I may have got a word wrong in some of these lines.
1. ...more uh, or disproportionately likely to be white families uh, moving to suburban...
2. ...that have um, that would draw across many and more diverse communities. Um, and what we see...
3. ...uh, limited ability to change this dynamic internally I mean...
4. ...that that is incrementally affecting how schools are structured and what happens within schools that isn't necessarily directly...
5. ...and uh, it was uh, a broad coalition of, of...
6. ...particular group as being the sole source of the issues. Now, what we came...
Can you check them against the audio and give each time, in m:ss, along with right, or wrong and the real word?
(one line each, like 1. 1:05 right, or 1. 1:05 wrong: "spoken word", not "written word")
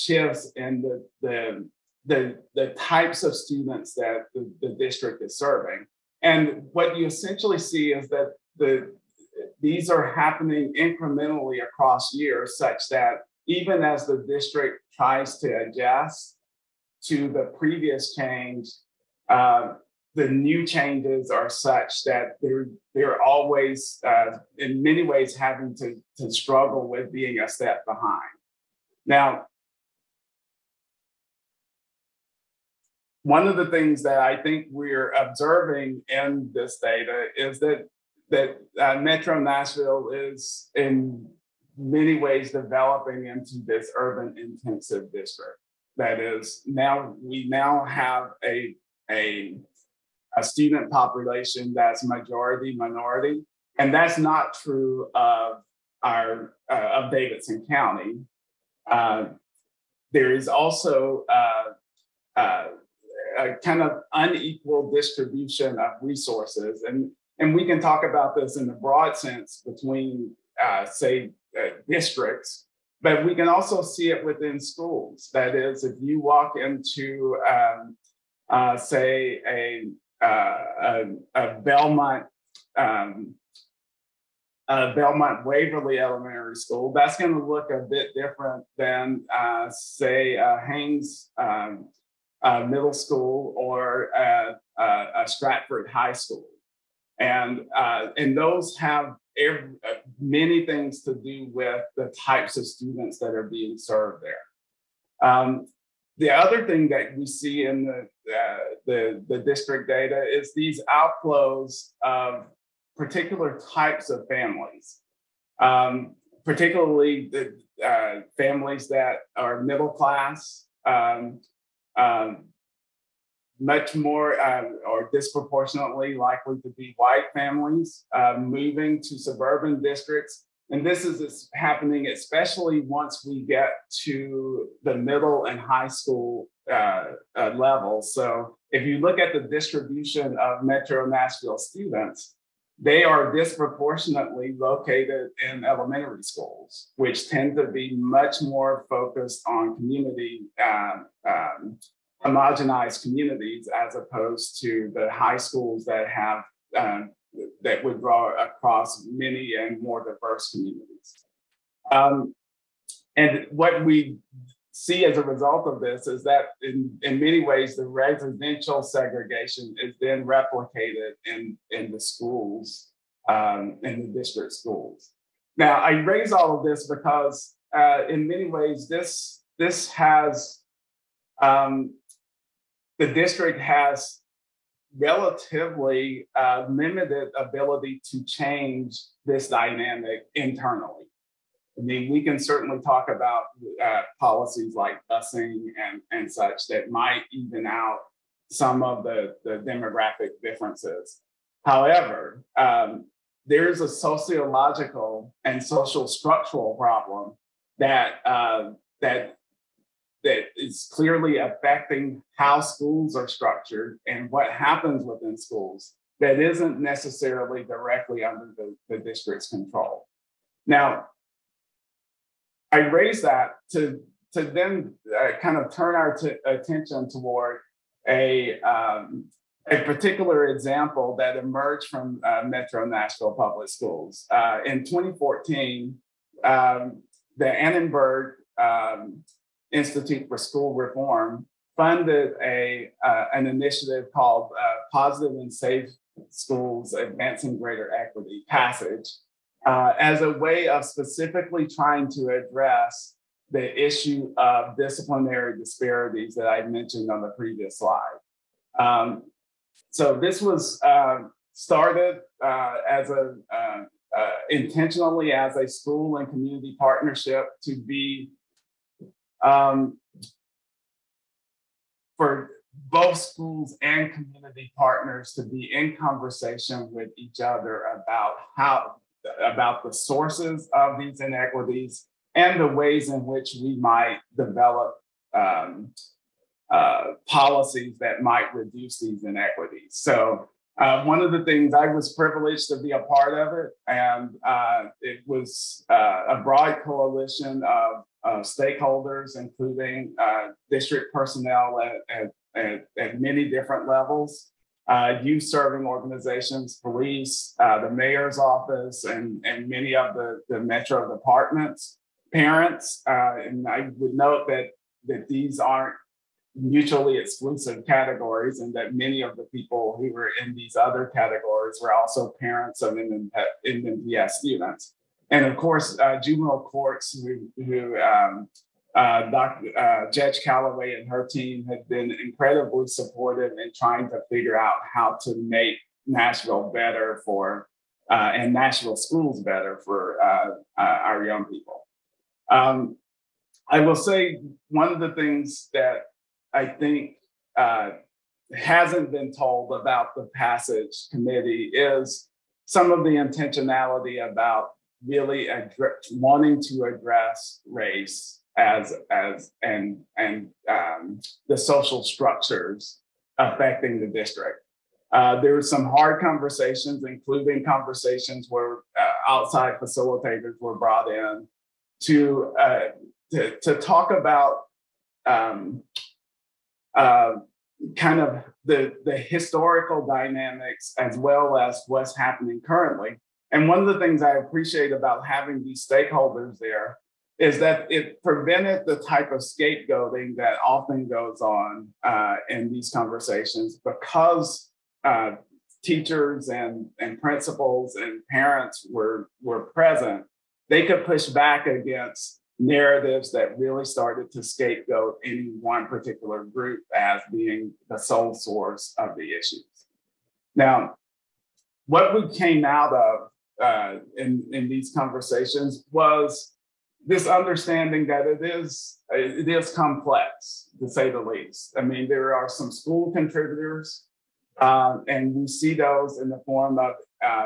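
1. 2:03 right
2. 2:35 right
3. 3:06 right
4. 3:28 wrong: "clearly", not "incrementally"
5. 4:53 right
6. 6:45 right.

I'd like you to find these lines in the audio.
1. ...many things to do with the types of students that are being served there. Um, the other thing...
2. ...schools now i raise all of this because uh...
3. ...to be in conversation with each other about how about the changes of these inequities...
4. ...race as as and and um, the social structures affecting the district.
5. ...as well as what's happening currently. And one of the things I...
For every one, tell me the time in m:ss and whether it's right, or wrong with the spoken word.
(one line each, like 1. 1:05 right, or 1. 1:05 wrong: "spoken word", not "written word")
1. 1:40 right
2. 2:54 right
3. 4:35 wrong: "sources", not "changes"
4. 5:57 right
5. 6:20 right.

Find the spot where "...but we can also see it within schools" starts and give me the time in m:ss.
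1:13.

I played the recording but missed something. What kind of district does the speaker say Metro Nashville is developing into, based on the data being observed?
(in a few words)
urban intensive district.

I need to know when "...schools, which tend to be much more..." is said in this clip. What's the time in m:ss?
2:26.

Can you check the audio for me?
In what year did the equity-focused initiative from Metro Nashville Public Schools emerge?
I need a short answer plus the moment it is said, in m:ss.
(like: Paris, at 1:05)
2014, at 3:54.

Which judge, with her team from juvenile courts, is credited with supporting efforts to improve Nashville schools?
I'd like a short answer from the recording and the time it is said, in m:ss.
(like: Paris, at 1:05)
Judge Calloway, at 5:30.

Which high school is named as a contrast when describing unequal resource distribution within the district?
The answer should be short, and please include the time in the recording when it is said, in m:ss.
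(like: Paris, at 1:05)
Stratford High School, at 1:35.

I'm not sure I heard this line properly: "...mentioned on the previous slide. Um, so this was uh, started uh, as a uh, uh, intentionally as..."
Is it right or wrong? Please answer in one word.
right.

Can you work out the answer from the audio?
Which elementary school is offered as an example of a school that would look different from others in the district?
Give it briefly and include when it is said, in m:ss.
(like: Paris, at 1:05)
Belmont Waverly Elementary School, at 1:24.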